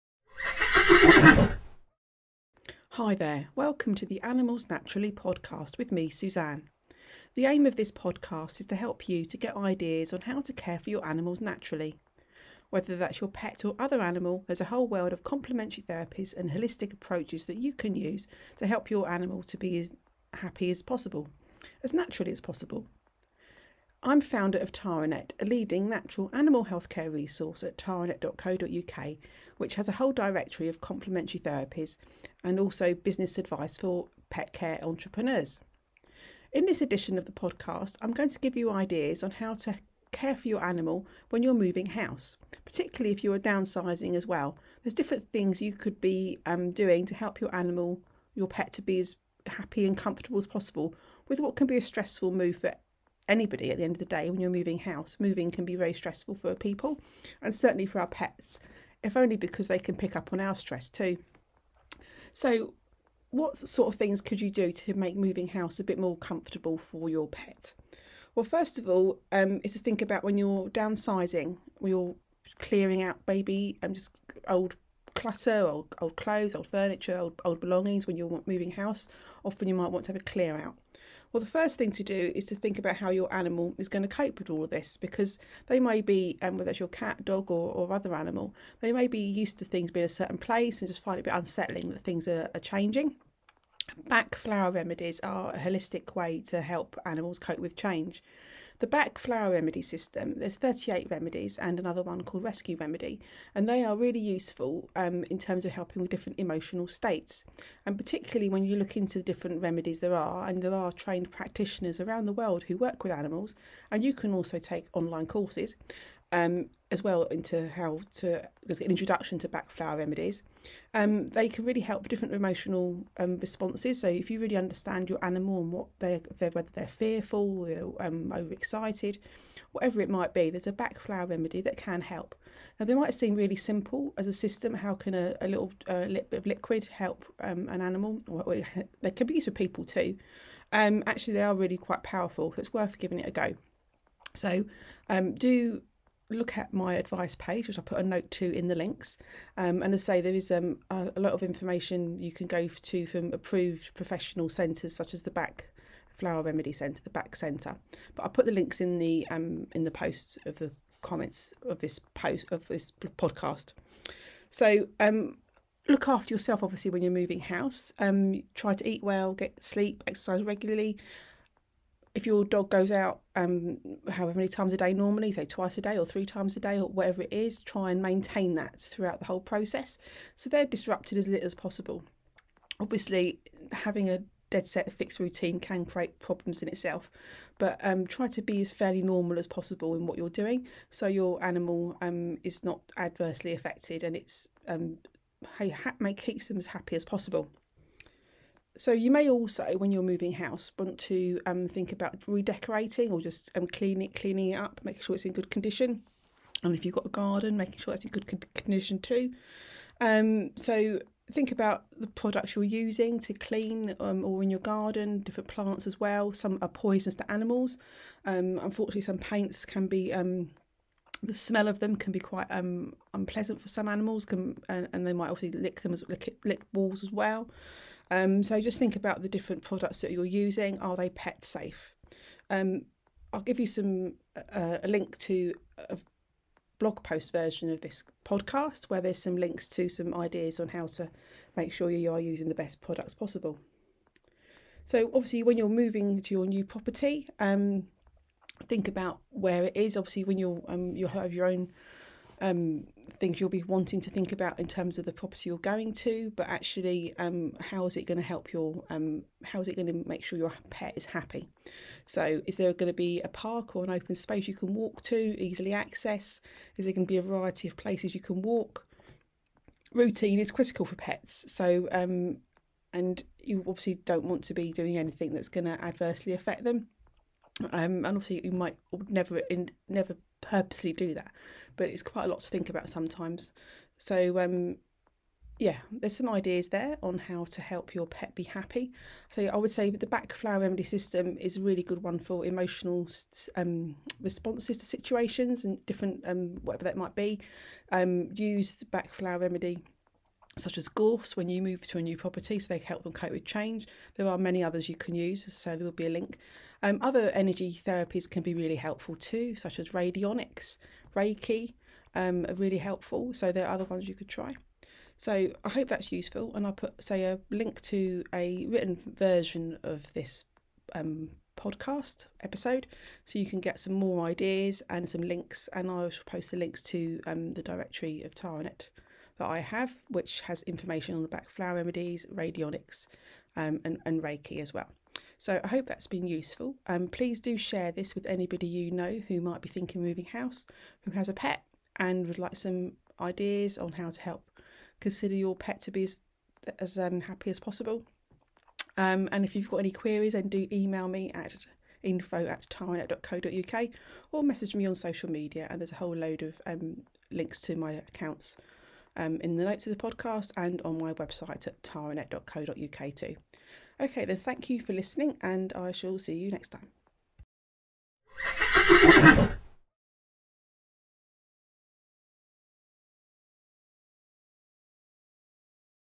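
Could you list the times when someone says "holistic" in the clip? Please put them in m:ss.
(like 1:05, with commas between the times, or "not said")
0:16, 1:35.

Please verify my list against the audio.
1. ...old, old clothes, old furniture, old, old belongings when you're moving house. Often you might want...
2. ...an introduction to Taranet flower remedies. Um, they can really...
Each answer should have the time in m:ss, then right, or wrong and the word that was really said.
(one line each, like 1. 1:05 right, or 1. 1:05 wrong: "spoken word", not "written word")
1. 1:15 right
2. 1:58 wrong: "Bach", not "Taranet".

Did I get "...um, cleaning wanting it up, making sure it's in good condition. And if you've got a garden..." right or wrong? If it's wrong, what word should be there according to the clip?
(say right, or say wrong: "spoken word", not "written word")
wrong: "cleaning", not "wanting".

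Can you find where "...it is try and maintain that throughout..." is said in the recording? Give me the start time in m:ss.
2:57.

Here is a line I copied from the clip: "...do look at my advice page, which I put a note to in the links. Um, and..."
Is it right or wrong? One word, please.
right.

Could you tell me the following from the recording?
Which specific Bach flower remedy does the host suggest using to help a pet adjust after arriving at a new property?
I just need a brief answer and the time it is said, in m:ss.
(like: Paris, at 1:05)
Gorse, at 5:00.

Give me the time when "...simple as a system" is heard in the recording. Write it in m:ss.
2:13.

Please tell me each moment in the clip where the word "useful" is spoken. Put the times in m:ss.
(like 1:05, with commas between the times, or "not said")
1:44, 5:16, 5:36.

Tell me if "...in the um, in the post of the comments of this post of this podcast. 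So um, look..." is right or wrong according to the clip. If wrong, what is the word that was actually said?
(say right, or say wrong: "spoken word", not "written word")
right.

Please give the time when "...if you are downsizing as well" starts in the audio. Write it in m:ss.
0:43.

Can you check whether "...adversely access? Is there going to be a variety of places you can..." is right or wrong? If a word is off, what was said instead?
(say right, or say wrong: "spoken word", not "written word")
wrong: "easily", not "adversely".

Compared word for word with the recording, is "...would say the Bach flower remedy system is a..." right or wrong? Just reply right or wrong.
right.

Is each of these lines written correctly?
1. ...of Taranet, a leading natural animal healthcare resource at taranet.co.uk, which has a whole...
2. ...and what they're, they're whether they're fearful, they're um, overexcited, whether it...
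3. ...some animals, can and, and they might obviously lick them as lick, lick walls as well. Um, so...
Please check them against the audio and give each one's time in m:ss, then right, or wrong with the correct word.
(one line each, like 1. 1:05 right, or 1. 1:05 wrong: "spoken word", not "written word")
1. 0:24 right
2. 2:05 wrong: "whatever", not "whether"
3. 3:43 right.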